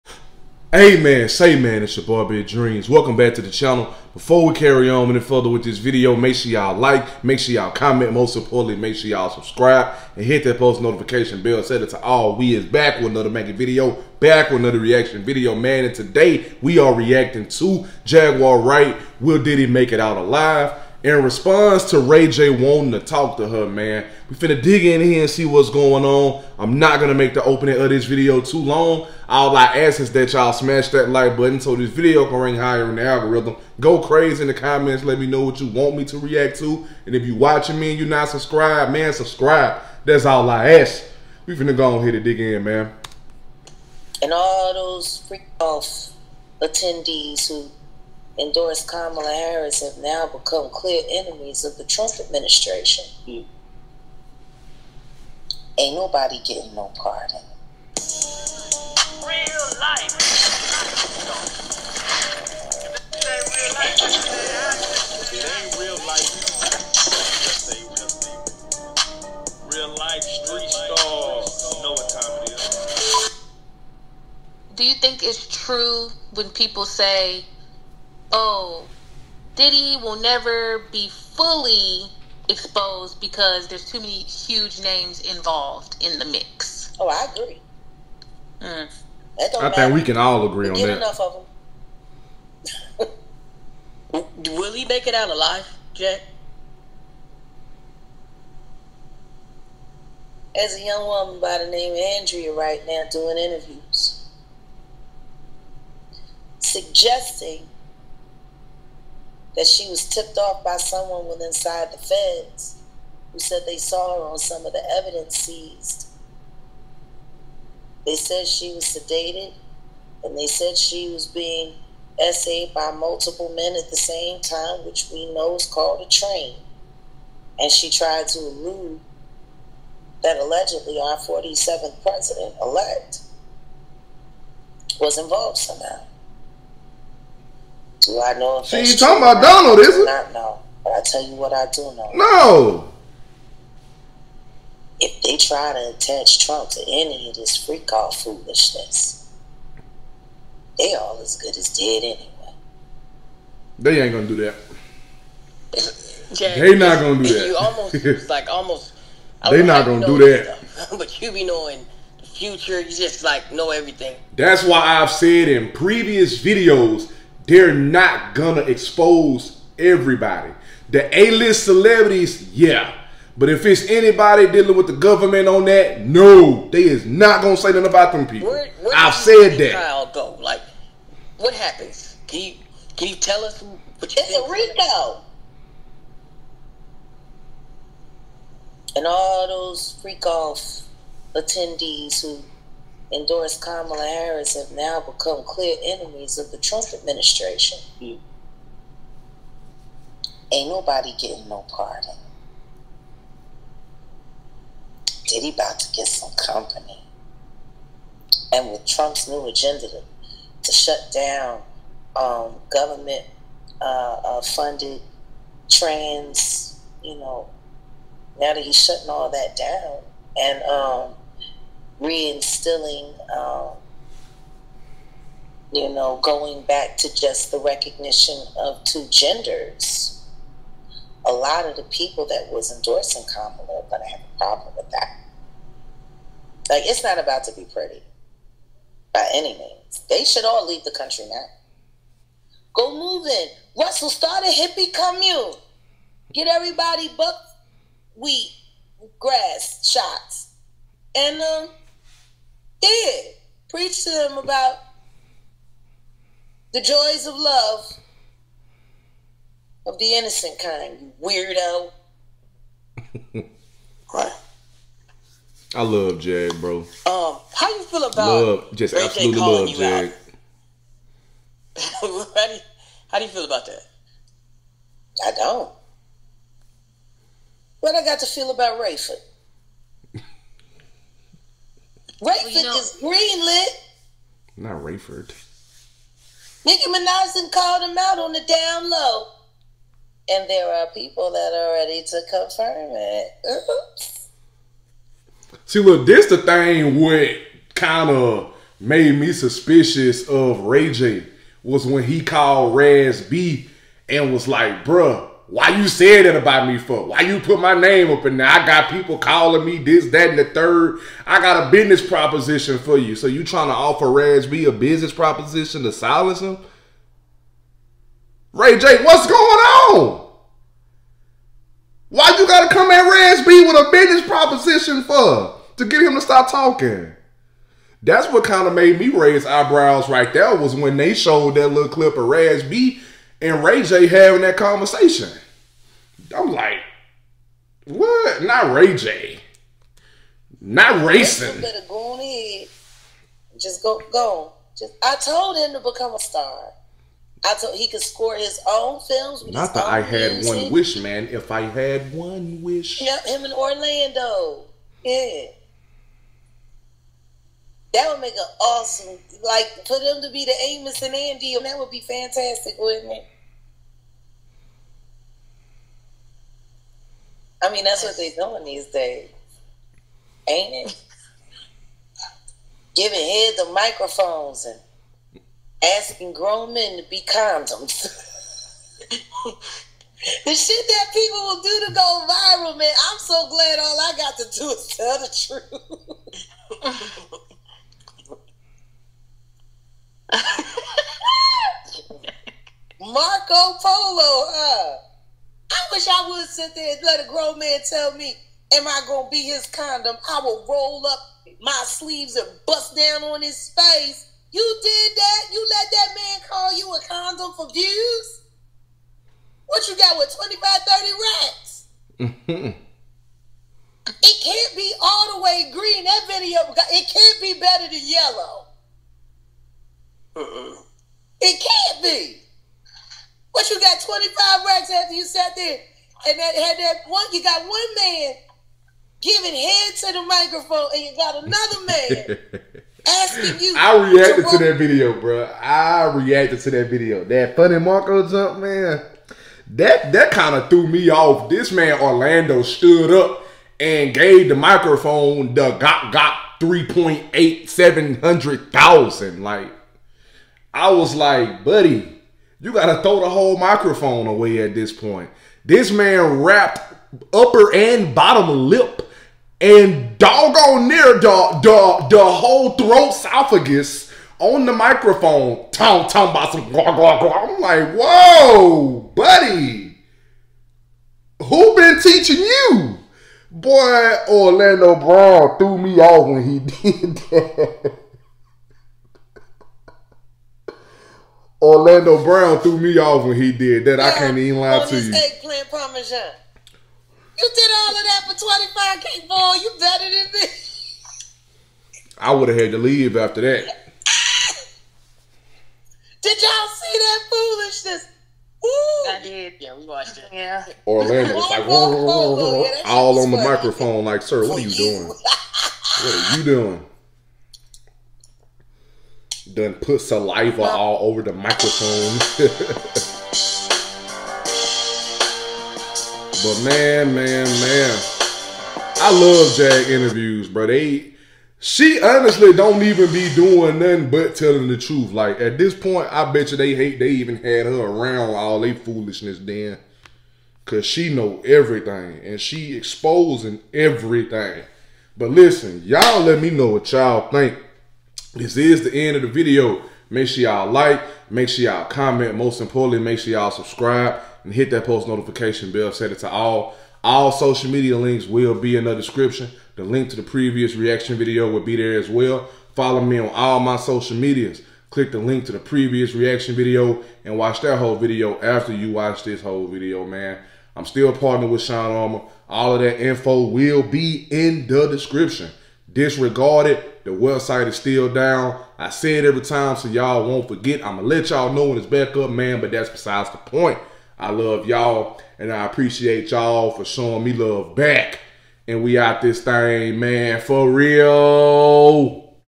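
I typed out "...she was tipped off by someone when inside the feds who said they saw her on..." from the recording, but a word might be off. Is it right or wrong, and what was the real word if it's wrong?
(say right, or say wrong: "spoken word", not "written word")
right.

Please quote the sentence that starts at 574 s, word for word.
I love y'all and I appreciate y'all for showing me love back.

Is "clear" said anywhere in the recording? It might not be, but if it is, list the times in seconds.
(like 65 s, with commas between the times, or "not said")
50 s, 195 s.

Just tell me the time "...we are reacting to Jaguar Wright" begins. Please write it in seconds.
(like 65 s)
16 s.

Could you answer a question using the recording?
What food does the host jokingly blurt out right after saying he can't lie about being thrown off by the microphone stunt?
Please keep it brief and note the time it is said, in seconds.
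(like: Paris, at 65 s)
Eggplant parmesan, at 485 s.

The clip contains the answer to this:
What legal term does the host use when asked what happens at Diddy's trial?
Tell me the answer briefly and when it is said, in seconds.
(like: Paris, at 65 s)
Rico, at 184 s.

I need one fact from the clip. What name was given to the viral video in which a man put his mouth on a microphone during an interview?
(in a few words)
Marco Polo.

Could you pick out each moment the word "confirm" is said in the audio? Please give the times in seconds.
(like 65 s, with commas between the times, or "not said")
292 s.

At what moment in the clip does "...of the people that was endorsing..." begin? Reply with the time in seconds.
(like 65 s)
231 s.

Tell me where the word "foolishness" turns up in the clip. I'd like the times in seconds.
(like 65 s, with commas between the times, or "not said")
148 s, 497 s, 528 s.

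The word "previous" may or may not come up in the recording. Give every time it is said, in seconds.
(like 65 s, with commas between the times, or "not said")
165 s, 550 s, 555 s.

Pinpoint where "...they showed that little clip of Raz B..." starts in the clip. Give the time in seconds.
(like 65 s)
330 s.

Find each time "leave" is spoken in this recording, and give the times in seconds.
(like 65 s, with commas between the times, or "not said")
240 s, 492 s.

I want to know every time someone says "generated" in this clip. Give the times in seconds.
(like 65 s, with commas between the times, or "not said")
not said.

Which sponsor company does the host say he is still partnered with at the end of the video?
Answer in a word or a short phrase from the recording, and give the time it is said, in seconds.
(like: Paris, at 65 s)
Shine Armor, at 561 s.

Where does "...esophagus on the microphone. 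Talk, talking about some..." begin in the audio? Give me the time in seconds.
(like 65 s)
463 s.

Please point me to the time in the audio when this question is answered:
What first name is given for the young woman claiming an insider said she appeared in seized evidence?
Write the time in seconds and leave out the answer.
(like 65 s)
102 s.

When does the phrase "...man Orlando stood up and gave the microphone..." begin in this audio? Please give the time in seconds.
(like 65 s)
441 s.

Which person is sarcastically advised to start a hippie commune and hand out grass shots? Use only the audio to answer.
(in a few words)
Russell.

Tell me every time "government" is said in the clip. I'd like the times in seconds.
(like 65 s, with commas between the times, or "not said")
174 s, 212 s.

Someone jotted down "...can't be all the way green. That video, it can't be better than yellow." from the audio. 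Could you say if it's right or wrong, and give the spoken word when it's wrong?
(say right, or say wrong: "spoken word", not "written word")
right.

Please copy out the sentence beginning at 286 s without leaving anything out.
Nicki Minaj and called him out on the down low.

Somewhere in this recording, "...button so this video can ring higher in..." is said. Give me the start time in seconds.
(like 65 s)
31 s.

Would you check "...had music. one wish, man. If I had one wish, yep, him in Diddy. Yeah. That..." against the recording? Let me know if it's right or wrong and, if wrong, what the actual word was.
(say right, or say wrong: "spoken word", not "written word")
wrong: "Orlando", not "Diddy".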